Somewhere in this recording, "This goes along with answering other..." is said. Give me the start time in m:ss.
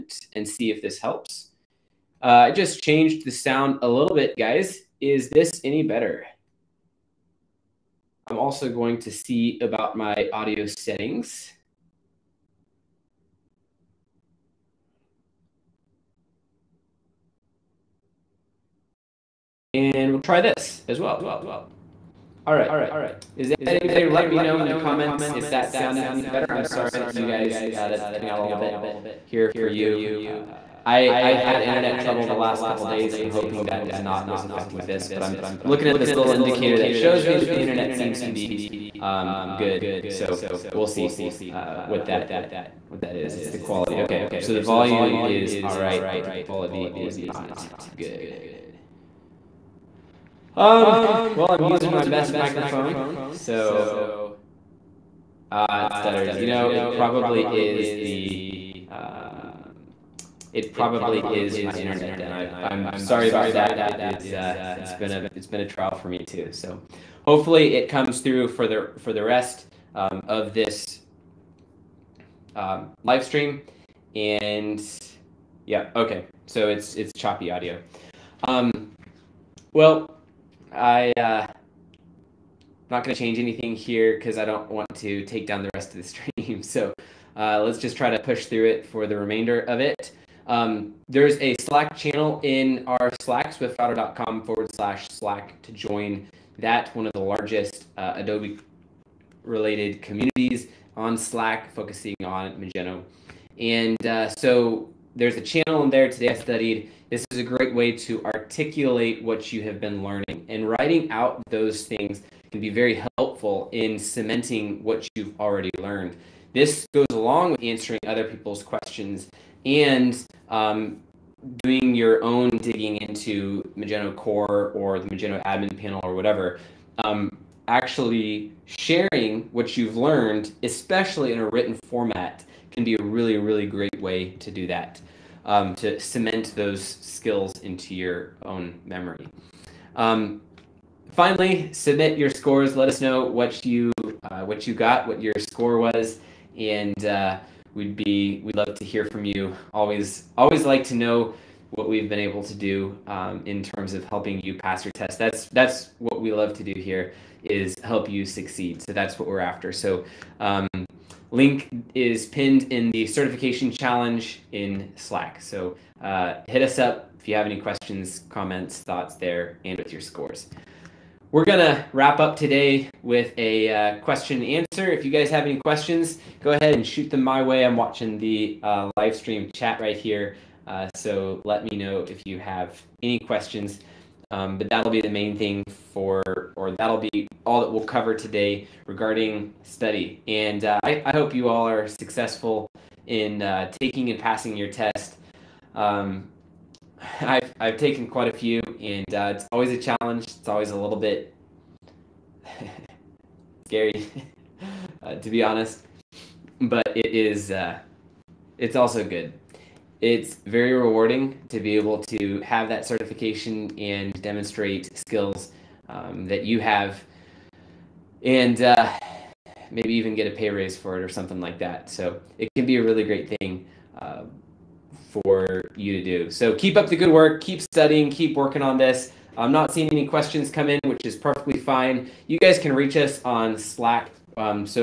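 1:56.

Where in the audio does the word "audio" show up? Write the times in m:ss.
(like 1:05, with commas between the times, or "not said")
0:10, 1:17.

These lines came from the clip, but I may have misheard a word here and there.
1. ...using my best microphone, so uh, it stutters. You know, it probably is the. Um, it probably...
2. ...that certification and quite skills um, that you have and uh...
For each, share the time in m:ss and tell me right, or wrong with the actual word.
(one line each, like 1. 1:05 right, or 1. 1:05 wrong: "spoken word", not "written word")
1. 0:51 right
2. 3:32 wrong: "demonstrate", not "quite".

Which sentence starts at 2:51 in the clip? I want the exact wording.
We're going to wrap up today with a uh, question and answer.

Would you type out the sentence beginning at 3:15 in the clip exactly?
Um, I've, I've taken quite a few, and uh, it's always a challenge.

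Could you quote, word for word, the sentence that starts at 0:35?
But I'm looking at this little indicator that shows me that the internet seems to be um, good.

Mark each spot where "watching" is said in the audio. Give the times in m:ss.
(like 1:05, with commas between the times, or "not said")
2:57.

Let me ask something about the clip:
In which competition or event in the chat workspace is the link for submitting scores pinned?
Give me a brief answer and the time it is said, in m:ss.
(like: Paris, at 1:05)
certification challenge, at 2:43.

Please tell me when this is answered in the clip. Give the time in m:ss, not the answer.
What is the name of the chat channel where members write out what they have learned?
1:46.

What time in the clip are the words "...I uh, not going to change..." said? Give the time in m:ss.
1:20.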